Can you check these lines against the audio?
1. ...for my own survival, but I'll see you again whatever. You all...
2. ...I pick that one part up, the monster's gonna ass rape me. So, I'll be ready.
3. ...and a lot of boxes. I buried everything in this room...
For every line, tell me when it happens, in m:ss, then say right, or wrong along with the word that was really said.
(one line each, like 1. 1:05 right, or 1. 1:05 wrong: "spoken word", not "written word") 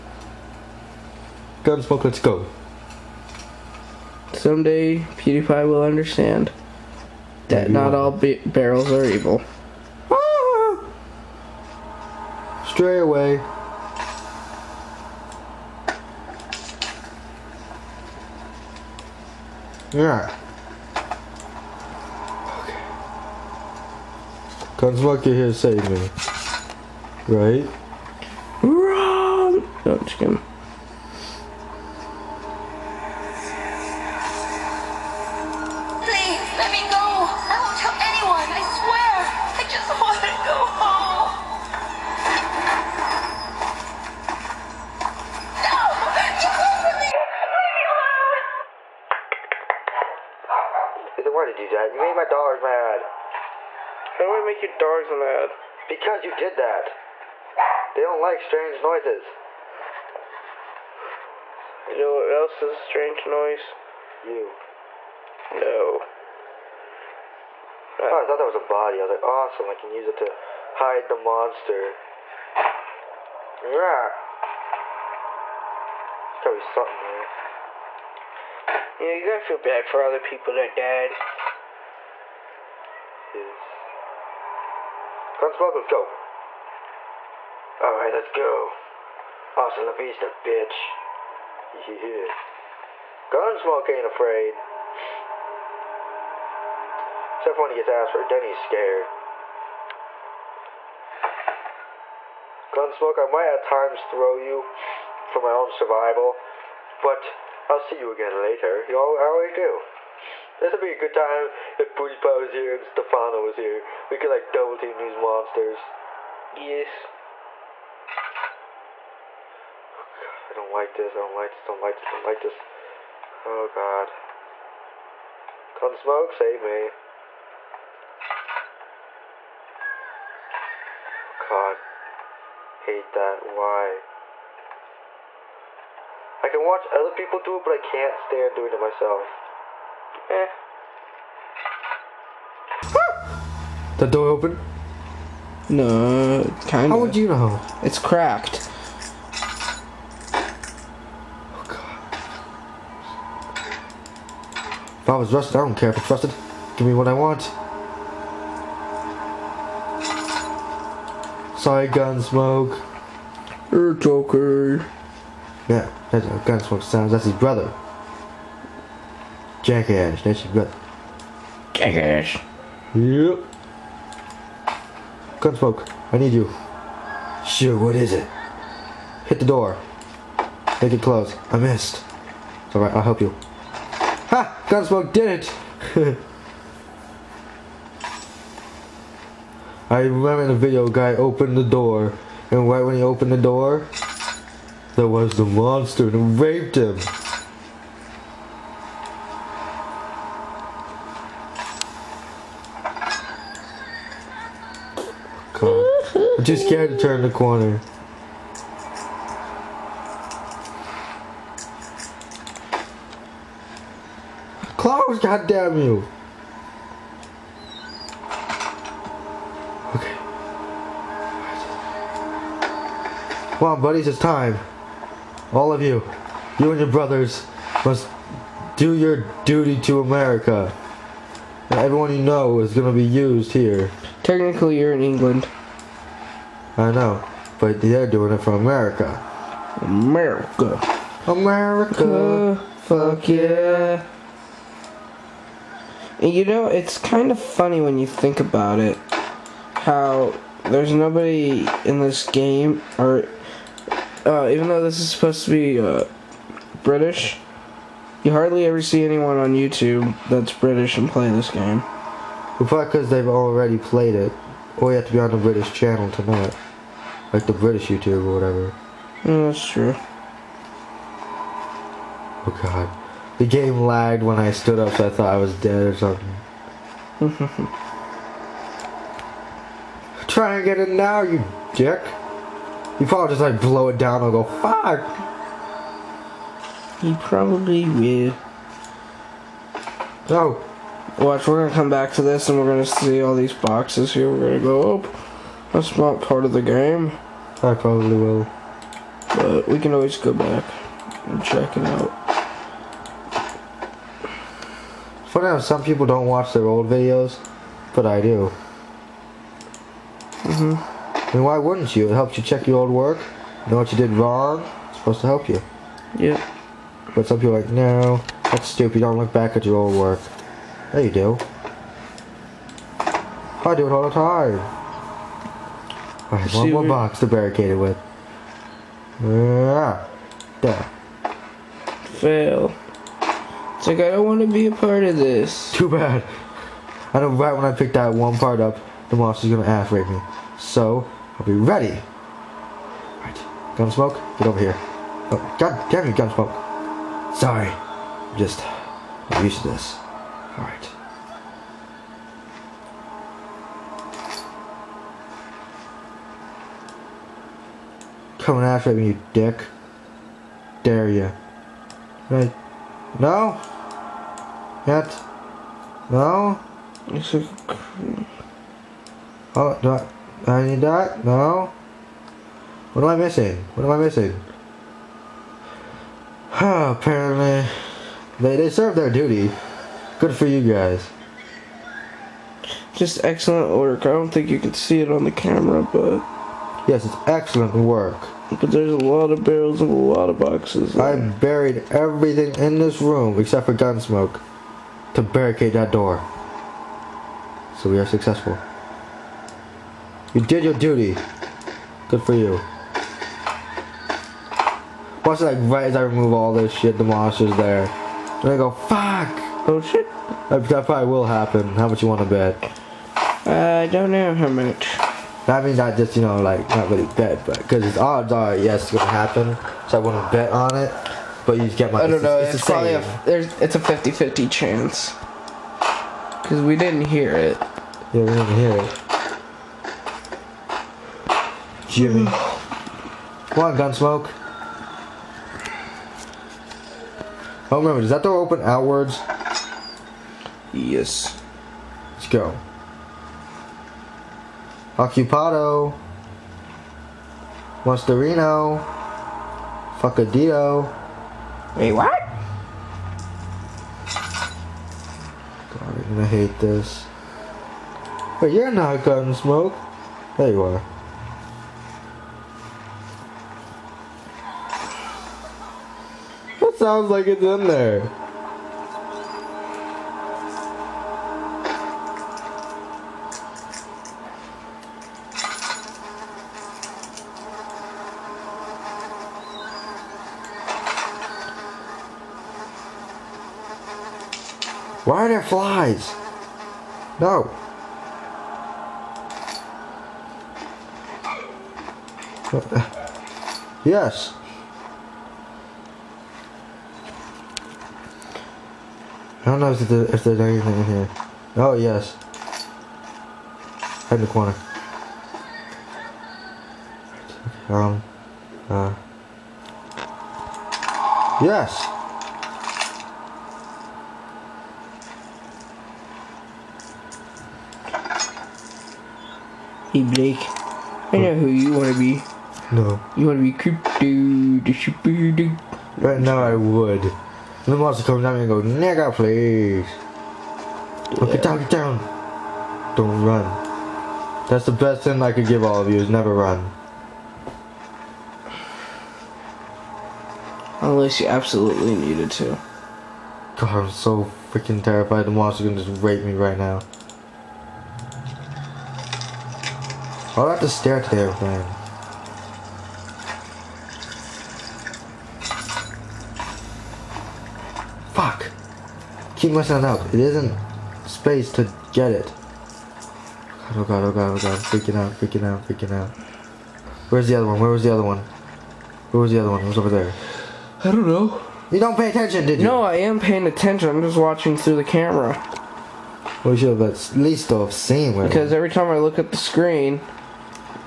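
1. 1:45 wrong: "later", not "whatever"
2. 5:37 right
3. 6:29 right.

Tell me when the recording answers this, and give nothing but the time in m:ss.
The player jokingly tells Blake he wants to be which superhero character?
8:43.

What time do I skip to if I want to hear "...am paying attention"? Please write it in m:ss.
9:32.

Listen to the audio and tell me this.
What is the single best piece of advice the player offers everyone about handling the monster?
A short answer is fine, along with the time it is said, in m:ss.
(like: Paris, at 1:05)
Never run, at 8:56.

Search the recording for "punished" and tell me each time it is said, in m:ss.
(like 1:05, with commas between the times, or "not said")
not said.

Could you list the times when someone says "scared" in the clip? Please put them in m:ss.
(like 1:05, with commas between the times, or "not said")
1:38, 3:26.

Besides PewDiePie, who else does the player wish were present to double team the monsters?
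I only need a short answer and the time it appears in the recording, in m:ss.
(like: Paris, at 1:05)
Stephano, at 1:52.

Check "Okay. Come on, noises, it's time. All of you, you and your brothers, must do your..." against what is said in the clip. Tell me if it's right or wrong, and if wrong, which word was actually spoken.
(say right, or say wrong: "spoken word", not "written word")
wrong: "buddies", not "noises".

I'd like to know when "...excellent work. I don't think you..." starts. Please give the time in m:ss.
6:23.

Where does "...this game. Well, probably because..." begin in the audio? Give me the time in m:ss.
4:21.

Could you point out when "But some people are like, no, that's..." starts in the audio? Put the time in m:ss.
5:17.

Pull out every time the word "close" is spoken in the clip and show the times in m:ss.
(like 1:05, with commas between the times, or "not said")
3:01, 3:34.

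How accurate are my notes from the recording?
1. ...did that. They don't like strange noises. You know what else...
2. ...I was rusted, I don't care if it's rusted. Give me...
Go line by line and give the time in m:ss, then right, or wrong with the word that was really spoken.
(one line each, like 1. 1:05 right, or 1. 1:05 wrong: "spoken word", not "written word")
1. 0:56 right
2. 2:35 right.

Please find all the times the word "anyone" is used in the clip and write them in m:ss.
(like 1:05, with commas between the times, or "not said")
0:37, 4:19.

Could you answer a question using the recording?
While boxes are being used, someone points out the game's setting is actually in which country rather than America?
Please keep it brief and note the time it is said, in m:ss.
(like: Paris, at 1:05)
England, at 3:55.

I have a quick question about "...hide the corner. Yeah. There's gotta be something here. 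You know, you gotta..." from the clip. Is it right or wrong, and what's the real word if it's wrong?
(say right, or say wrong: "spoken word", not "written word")
wrong: "monster", not "corner".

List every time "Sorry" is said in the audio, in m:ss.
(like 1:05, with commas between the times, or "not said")
2:41, 5:47.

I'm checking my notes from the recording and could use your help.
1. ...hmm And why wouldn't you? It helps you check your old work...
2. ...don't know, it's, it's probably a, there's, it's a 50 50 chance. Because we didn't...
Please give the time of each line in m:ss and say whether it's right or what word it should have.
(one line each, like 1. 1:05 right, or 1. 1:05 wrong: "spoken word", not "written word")
1. 5:10 right
2. 7:02 right.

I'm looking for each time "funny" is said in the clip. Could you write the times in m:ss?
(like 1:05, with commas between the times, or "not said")
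4:07, 5:05.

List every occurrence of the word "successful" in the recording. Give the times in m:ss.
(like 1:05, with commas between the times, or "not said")
6:38.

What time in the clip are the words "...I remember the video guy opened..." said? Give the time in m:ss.
3:09.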